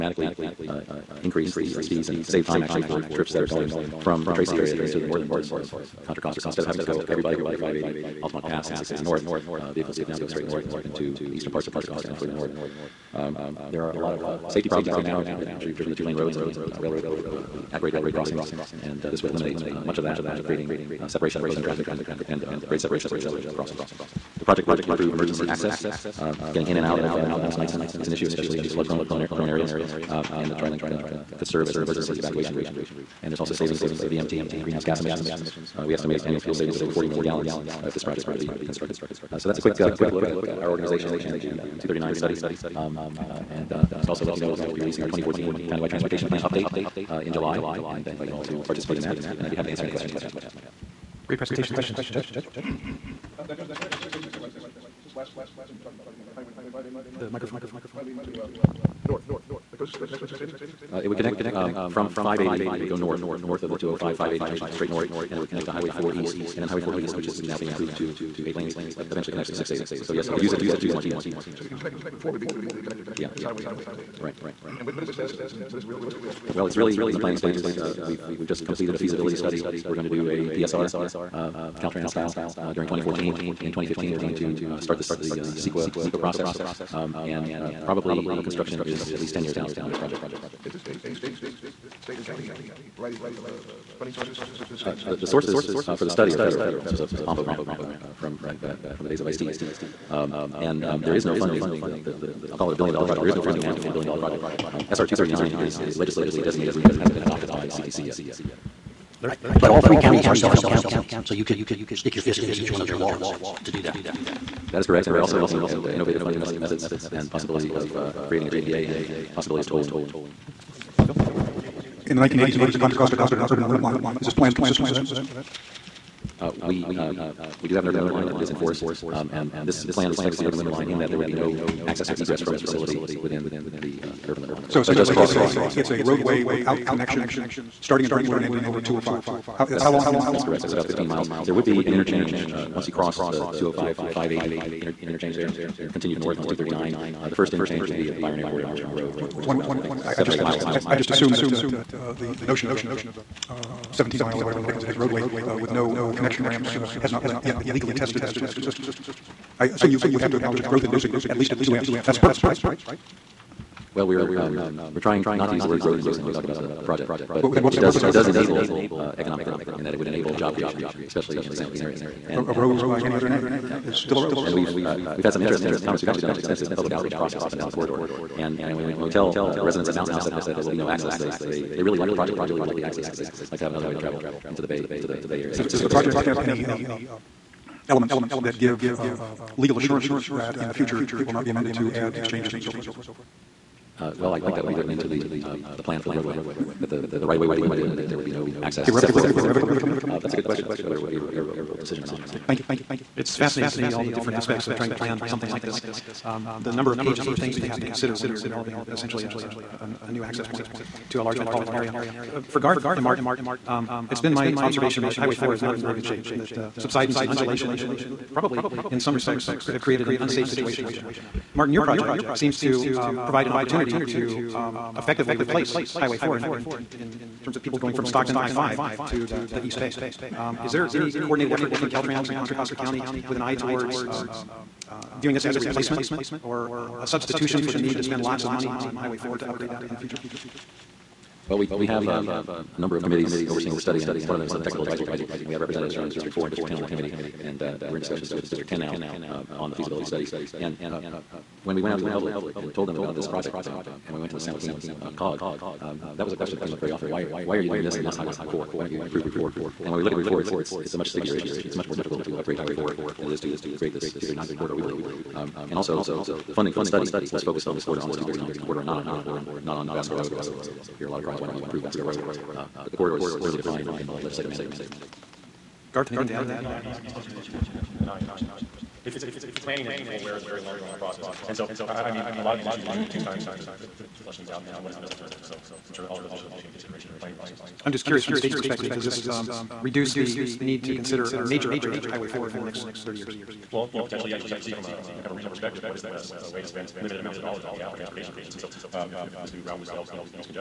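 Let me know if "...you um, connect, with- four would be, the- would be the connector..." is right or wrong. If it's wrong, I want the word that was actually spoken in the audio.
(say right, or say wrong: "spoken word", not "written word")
right.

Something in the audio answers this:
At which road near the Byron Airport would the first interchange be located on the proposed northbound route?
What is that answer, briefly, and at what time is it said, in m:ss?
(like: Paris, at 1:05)
Armstrong Road, at 2:28.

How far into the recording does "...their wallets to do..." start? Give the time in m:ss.
1:52.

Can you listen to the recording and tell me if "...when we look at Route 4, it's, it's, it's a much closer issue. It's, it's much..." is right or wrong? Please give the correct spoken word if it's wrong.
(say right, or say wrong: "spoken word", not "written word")
wrong: "stickier", not "closer".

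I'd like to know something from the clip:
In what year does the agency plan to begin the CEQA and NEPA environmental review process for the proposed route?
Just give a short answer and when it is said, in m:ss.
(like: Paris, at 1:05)
2015, at 1:23.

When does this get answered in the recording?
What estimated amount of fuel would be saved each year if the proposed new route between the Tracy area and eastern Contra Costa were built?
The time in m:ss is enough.
0:36.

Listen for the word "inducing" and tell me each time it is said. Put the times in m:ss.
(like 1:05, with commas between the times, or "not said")
2:40, 2:45.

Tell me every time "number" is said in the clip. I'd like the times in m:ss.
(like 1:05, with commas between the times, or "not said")
3:26, 4:02.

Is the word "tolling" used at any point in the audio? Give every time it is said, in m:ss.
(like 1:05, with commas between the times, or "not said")
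1:59.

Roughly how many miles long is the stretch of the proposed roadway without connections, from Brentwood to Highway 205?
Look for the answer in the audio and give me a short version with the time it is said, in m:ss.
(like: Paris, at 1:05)
15 miles, at 2:20.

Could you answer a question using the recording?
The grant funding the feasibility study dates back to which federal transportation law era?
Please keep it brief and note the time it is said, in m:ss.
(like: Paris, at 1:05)
ISTEA, at 1:39.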